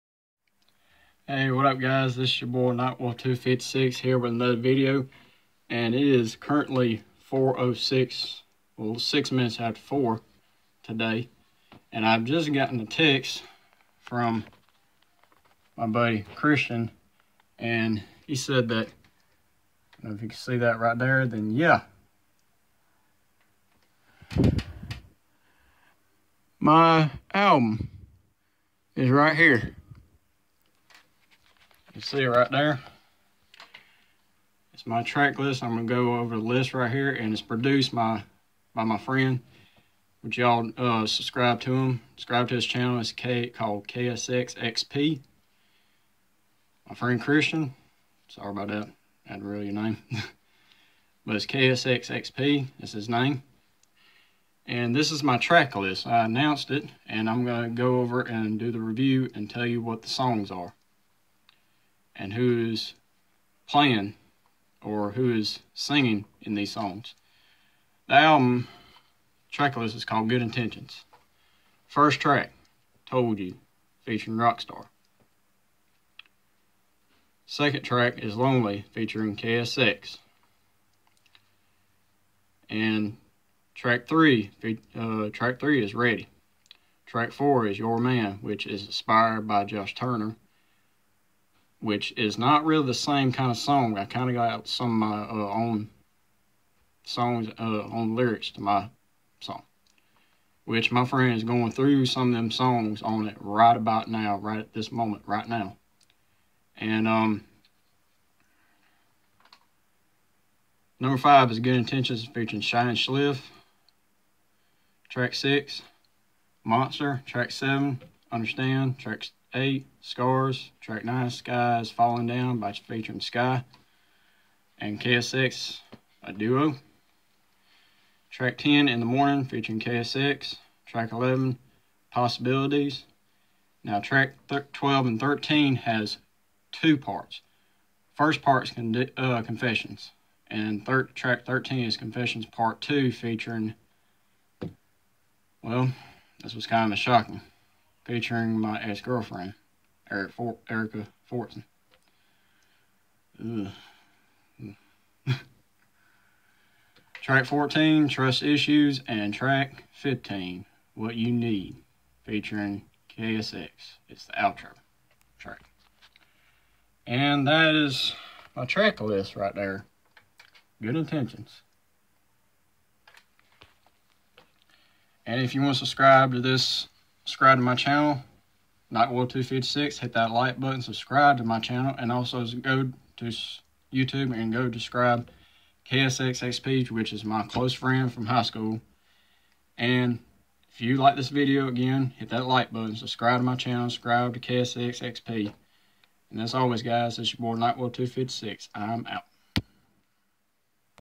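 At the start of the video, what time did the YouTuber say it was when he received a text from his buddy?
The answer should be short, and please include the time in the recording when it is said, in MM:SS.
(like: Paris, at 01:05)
4:06, at 00:07.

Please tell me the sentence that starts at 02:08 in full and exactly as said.
Track 10, In the Morning, featuring KSX.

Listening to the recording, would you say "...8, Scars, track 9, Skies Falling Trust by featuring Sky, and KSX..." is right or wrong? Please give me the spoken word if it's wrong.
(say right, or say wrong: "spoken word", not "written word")
wrong: "Down", not "Trust".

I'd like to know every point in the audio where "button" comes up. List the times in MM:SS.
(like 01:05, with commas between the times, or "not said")
03:00, 03:12.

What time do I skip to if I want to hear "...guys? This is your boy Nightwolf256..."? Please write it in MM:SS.
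00:01.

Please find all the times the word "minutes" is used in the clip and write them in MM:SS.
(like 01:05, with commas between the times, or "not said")
00:09.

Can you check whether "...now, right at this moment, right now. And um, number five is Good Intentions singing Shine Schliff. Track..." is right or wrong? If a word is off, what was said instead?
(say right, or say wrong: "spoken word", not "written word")
wrong: "featuring", not "singing".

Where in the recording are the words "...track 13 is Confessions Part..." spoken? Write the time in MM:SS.
02:21.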